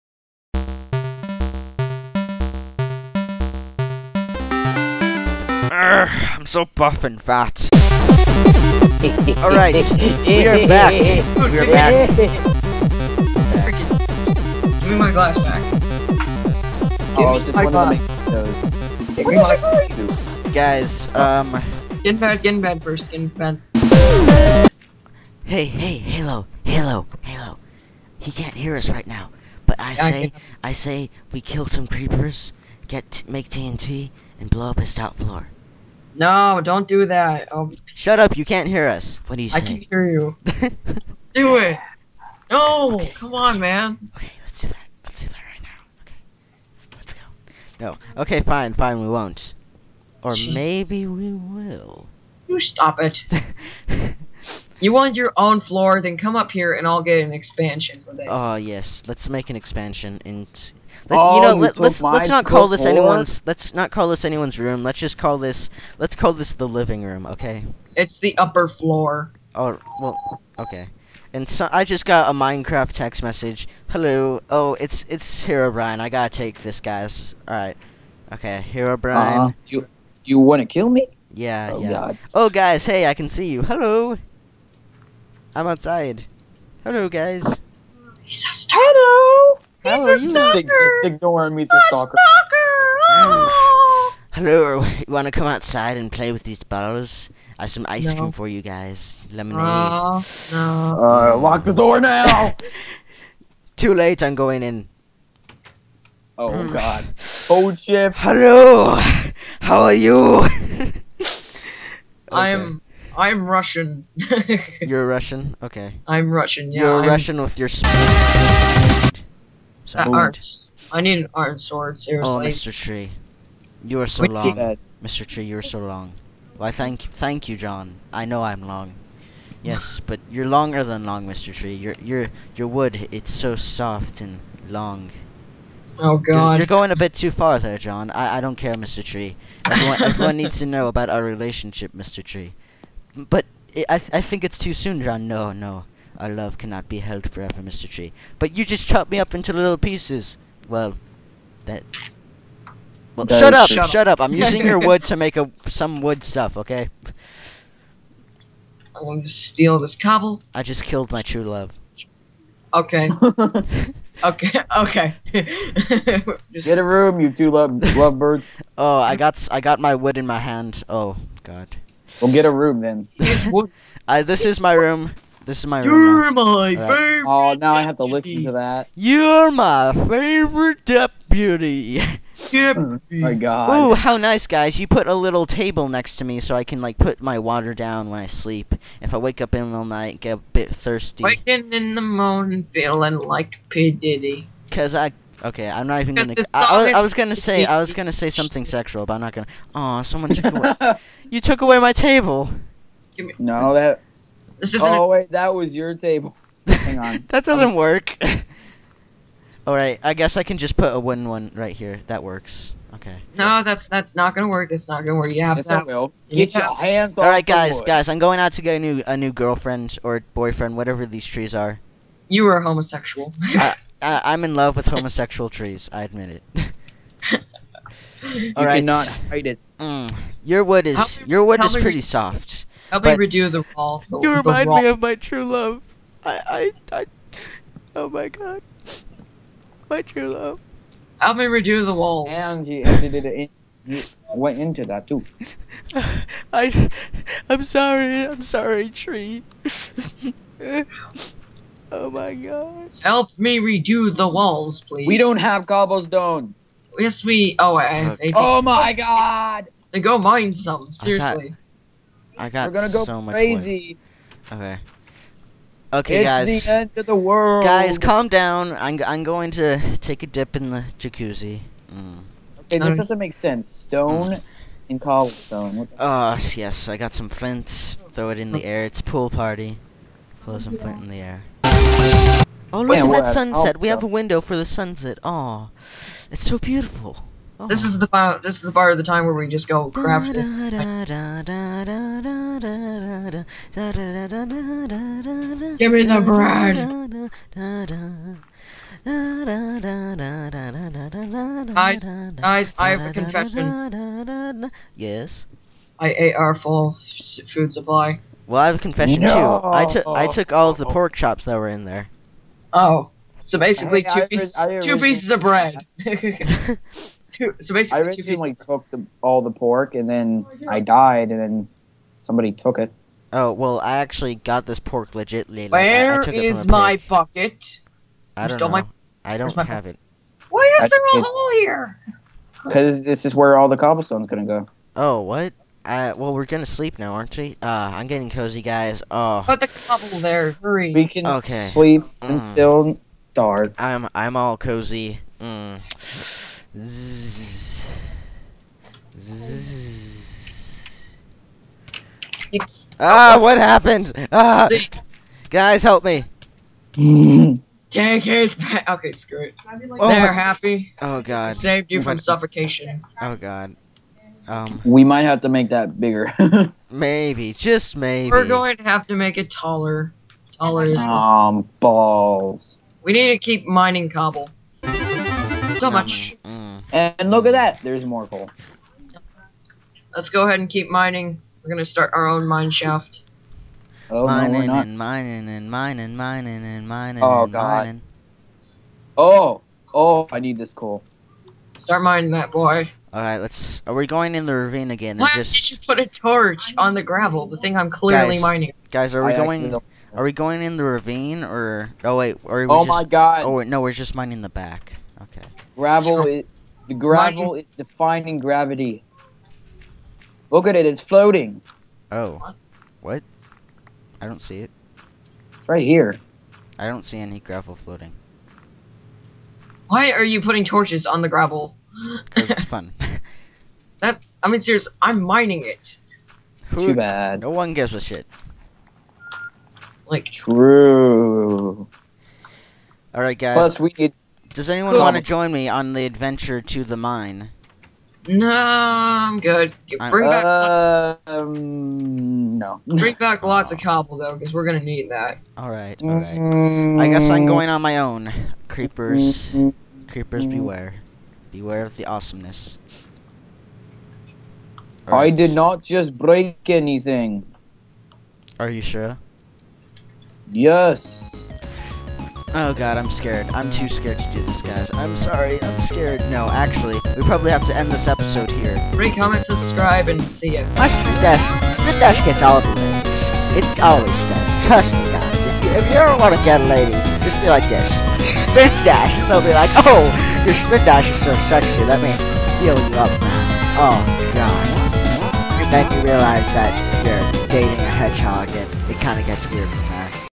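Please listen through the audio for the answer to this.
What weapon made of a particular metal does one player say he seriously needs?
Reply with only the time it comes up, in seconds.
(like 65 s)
121 s.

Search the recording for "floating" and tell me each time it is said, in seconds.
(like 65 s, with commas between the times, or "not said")
410 s, 417 s.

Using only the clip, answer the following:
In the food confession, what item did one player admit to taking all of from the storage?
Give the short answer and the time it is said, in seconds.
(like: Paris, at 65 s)
pork chops, at 310 s.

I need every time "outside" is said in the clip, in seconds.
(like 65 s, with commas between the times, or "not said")
85 s, 95 s.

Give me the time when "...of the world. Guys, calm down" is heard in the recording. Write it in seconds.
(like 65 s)
266 s.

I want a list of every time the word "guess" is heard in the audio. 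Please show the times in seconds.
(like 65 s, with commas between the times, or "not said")
210 s, 447 s.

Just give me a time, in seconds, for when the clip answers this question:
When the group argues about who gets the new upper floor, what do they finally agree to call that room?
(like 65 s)
66 s.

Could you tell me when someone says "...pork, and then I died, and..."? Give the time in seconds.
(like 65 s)
319 s.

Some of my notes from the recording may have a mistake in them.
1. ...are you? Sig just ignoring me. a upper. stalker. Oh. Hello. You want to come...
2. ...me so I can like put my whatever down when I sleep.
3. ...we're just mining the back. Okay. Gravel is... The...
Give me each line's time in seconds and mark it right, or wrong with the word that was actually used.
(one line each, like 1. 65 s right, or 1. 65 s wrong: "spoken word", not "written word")
1. 90 s wrong: "stalker", not "upper"
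2. 186 s wrong: "water", not "whatever"
3. 403 s right.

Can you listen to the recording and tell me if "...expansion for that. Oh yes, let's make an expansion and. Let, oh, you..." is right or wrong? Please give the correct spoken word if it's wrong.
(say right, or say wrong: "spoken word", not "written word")
right.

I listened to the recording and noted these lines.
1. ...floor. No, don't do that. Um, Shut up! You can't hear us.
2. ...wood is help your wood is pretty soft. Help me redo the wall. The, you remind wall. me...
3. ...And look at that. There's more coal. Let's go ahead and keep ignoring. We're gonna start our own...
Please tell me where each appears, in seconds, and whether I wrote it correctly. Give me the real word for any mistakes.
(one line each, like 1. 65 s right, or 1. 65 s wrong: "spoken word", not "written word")
1. 35 s right
2. 230 s right
3. 376 s wrong: "mining", not "ignoring".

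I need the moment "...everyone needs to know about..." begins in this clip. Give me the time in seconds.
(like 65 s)
140 s.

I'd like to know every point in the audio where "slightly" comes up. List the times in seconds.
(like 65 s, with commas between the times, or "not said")
not said.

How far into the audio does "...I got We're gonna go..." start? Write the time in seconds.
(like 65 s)
262 s.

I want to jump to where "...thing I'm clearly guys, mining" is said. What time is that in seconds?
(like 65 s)
397 s.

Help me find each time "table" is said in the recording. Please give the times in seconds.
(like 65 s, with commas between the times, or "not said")
185 s, 201 s, 205 s.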